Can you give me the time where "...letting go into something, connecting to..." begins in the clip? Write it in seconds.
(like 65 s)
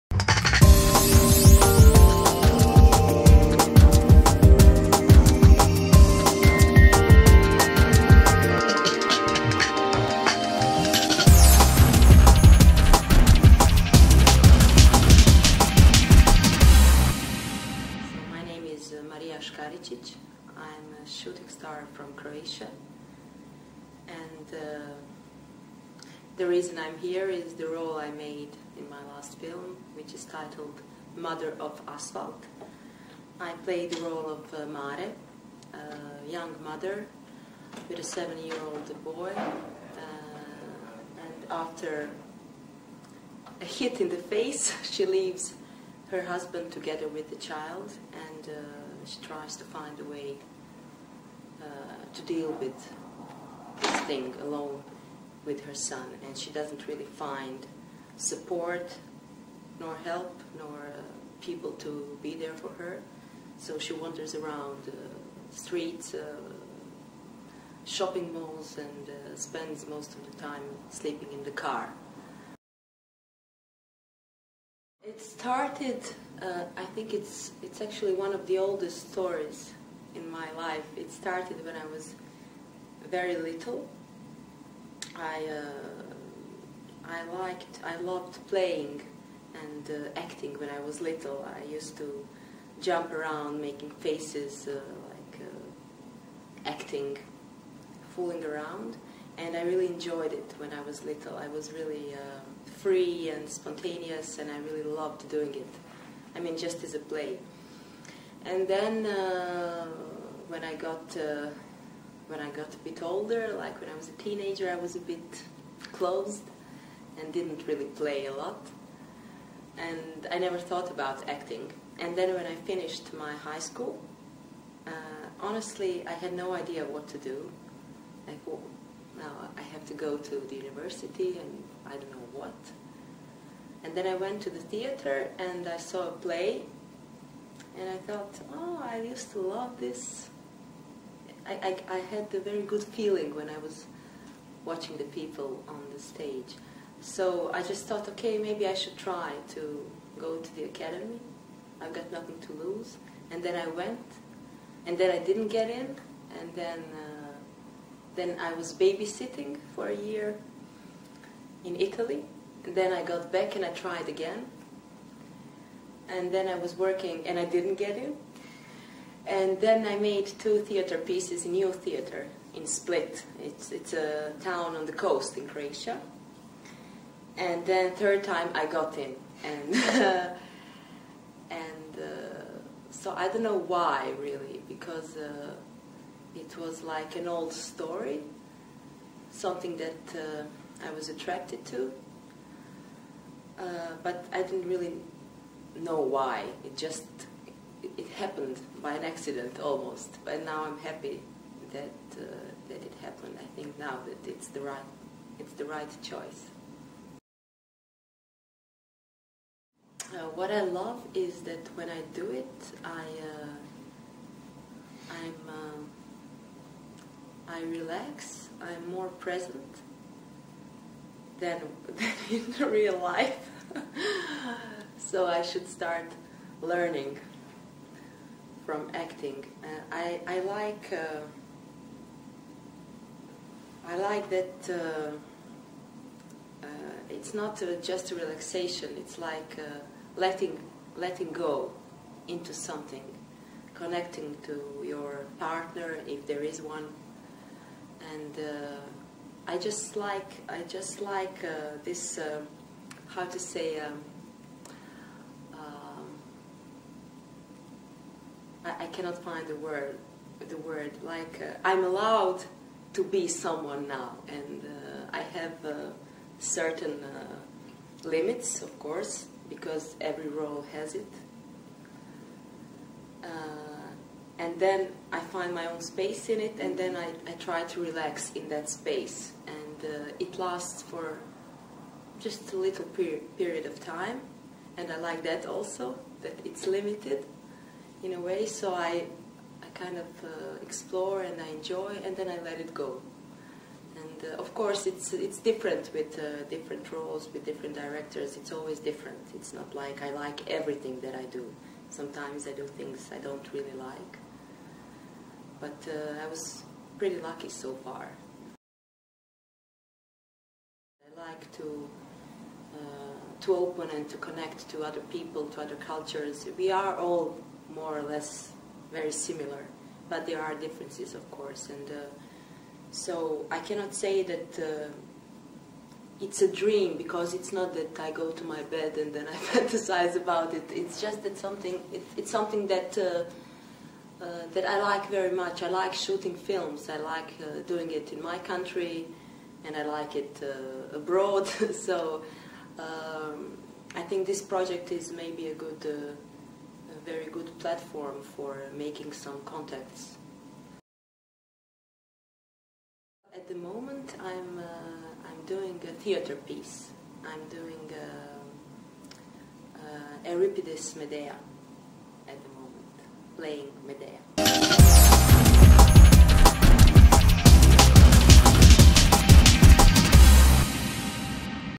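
240 s.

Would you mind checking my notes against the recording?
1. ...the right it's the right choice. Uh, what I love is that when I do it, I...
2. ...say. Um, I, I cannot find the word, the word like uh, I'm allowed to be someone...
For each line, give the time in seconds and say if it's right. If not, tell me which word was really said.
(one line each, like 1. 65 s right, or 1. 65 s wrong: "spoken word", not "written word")
1. 204 s right
2. 253 s right.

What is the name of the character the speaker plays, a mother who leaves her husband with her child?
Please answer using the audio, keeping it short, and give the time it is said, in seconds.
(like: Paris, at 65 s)
Mare, at 34 s.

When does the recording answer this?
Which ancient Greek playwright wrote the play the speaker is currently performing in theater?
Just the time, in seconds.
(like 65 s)
360 s.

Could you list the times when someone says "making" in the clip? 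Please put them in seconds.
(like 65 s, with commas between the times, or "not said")
93 s, 348 s.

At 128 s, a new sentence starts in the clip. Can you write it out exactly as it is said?
Like, oh, now I have to go to the university and I don't know what.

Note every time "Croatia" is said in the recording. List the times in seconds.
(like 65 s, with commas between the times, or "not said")
175 s.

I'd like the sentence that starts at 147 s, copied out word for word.
So I just thought, okay, maybe I should try to go to the academy.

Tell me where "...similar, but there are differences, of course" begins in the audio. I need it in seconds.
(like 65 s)
319 s.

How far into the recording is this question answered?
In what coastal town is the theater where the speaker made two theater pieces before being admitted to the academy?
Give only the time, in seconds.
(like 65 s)
172 s.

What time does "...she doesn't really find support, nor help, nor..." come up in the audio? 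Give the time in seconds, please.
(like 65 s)
56 s.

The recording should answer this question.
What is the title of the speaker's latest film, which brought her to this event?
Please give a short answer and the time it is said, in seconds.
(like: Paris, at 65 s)
Mother of Asphalt, at 31 s.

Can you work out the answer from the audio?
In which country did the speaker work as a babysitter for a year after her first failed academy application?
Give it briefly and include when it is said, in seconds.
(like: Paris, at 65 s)
Italy, at 161 s.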